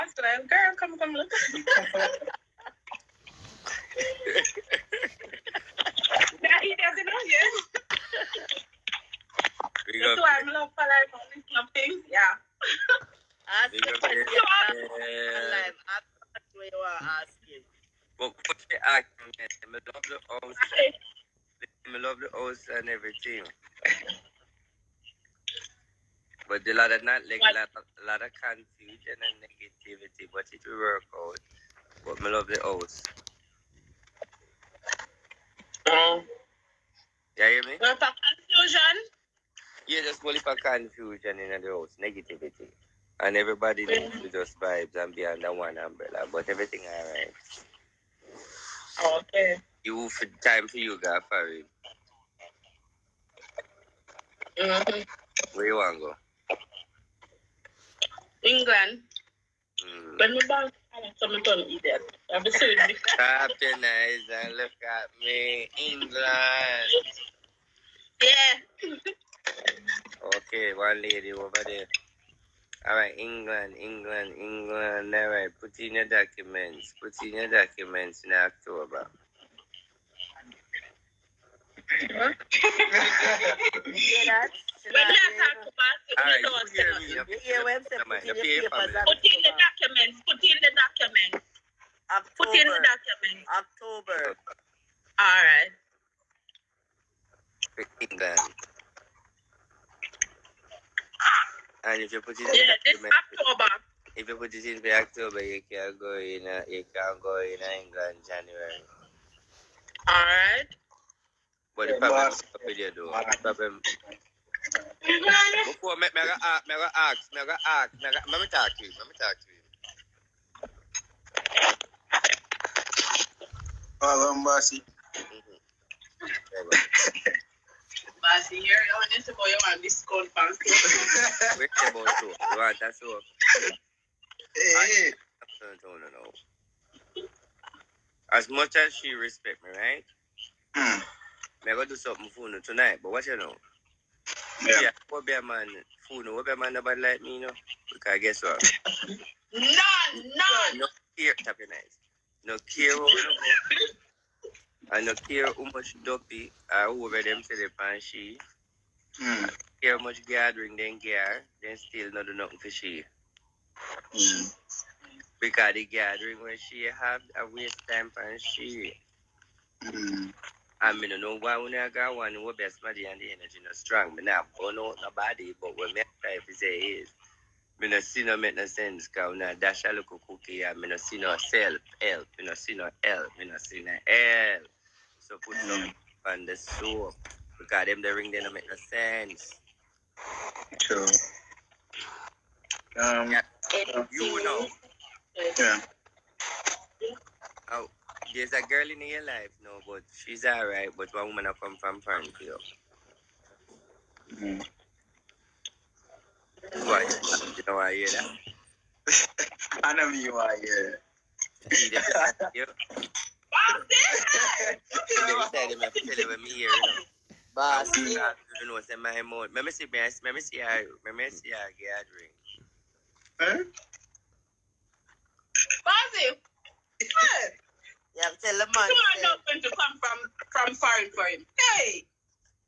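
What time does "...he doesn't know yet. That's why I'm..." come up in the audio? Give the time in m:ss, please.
0:06.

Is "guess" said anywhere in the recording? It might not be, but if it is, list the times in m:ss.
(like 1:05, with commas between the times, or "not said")
2:28.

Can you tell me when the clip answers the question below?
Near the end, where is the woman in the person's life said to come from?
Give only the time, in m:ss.
3:21.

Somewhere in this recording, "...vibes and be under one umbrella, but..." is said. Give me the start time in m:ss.
0:44.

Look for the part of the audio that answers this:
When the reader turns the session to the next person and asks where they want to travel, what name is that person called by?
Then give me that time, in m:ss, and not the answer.
0:50.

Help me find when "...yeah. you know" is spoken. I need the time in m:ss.
3:13.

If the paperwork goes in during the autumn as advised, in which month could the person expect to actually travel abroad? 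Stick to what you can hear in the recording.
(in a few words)
January.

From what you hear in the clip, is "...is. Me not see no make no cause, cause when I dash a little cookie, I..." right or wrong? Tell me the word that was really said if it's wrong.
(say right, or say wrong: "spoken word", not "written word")
wrong: "sense", not "cause".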